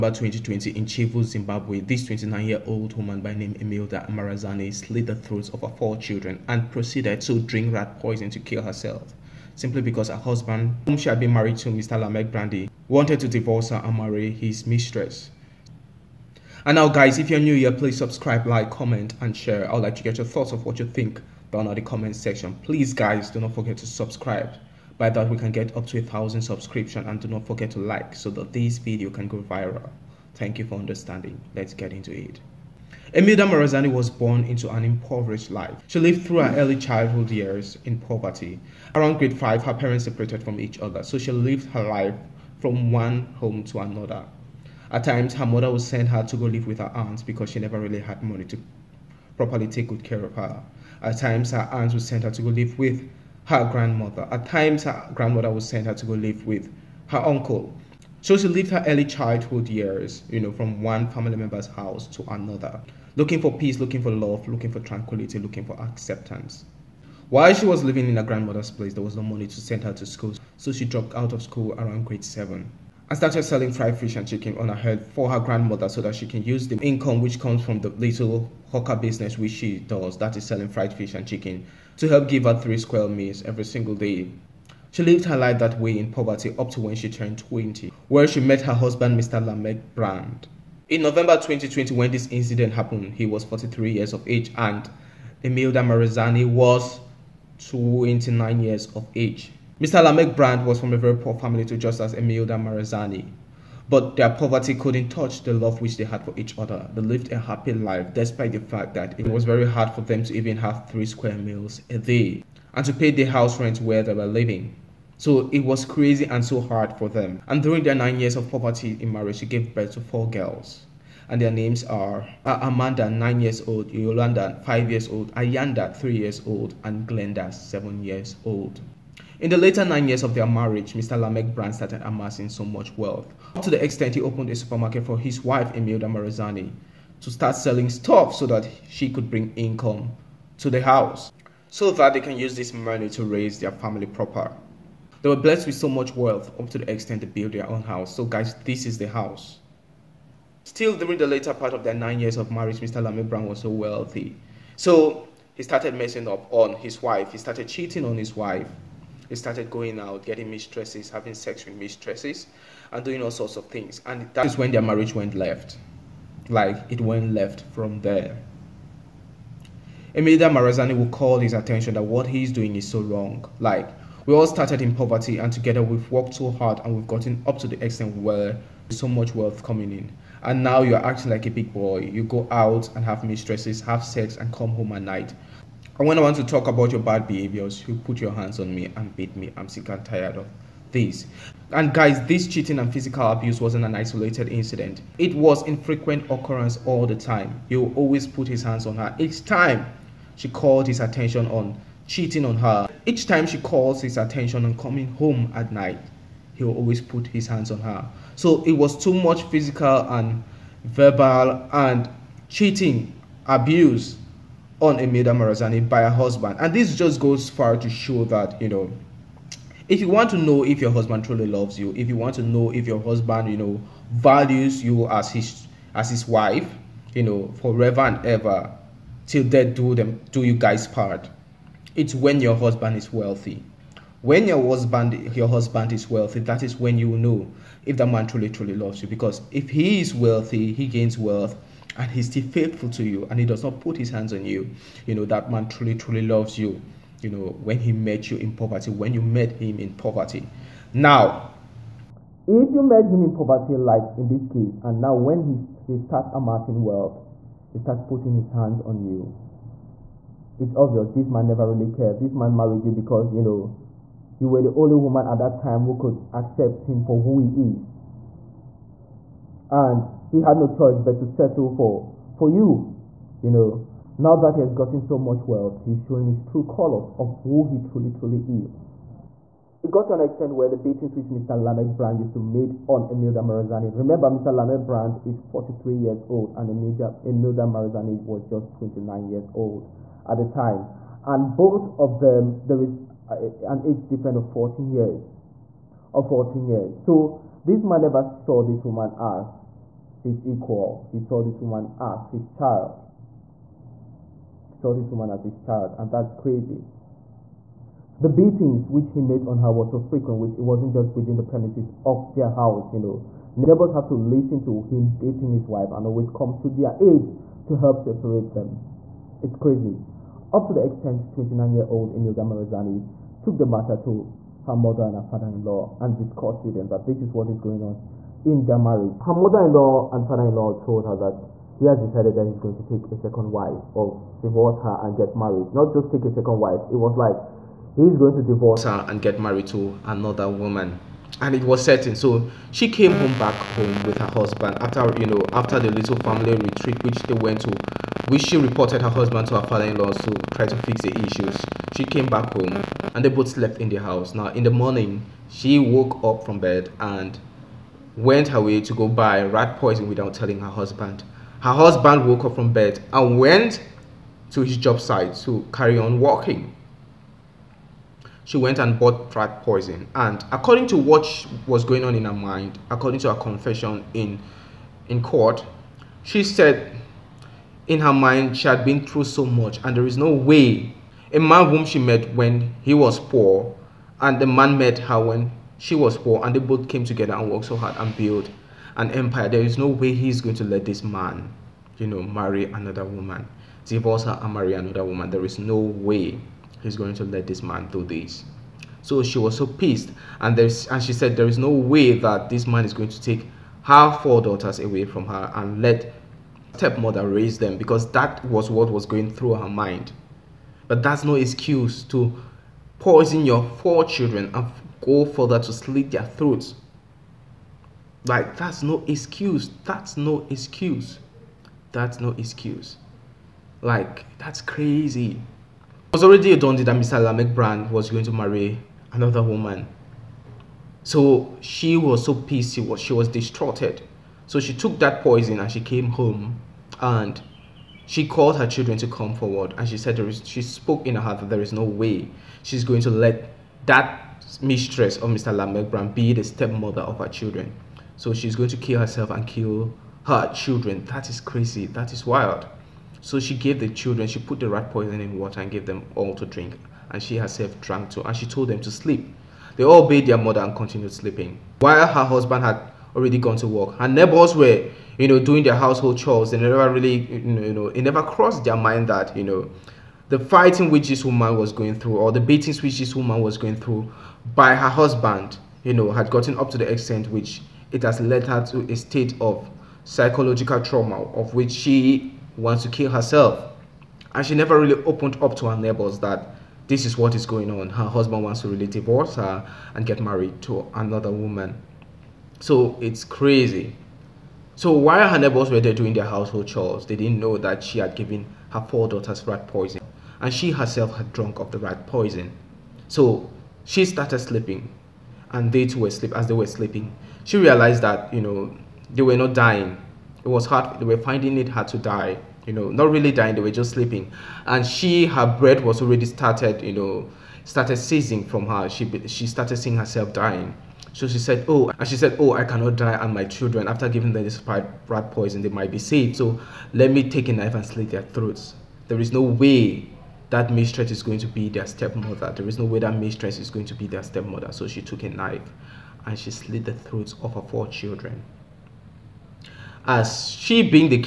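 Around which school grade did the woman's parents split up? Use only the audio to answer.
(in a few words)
Grade 5.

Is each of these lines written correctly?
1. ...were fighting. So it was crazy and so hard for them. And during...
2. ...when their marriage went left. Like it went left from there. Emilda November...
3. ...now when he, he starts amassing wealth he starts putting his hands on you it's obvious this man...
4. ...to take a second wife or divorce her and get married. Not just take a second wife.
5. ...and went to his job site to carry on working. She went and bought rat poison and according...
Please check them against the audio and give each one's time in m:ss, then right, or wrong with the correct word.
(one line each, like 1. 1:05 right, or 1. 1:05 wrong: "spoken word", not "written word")
1. 1:54 wrong: "living", not "fighting"
2. 2:44 wrong: "Marazani", not "November"
3. 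4:14 right
4. 5:32 right
5. 6:03 right.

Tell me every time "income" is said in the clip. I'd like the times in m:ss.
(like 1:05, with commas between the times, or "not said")
1:16, 2:19.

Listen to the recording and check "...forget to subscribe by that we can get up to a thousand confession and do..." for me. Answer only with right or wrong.
wrong.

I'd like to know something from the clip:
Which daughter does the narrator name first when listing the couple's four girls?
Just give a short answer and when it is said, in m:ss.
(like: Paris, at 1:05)
Amanda, at 2:02.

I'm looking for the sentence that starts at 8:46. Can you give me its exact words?
So let me take a knife and slit their throats.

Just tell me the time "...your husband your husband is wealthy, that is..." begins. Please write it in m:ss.
3:54.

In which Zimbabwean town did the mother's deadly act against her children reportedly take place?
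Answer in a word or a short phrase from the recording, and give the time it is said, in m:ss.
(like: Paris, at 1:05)
Chivhu, at 0:00.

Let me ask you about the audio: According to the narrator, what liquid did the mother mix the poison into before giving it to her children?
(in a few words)
Water.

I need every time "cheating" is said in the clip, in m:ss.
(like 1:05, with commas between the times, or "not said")
2:37, 3:12, 3:22, 3:32.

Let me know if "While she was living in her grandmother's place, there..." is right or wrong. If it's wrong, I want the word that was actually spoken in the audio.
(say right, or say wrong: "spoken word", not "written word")
right.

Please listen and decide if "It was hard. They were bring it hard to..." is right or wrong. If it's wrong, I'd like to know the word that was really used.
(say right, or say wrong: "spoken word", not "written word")
wrong: "finding", not "bring".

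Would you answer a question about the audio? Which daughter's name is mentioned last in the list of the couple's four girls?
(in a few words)
Glenda.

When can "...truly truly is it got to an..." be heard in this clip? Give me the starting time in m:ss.
4:37.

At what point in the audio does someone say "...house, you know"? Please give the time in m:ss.
5:12.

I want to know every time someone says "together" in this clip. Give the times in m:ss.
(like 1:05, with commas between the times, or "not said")
2:55, 6:27.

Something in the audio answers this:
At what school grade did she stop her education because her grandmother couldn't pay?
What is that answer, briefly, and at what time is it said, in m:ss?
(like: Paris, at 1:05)
Grade 7, at 1:12.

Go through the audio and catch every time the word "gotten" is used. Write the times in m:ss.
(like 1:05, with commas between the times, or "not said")
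2:57, 4:34, 7:56.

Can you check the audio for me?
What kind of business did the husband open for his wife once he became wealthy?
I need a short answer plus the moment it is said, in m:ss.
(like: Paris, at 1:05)
A supermarket, at 2:14.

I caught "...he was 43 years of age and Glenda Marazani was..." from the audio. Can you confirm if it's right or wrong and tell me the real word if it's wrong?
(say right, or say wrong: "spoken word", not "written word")
wrong: "Emilda", not "Glenda".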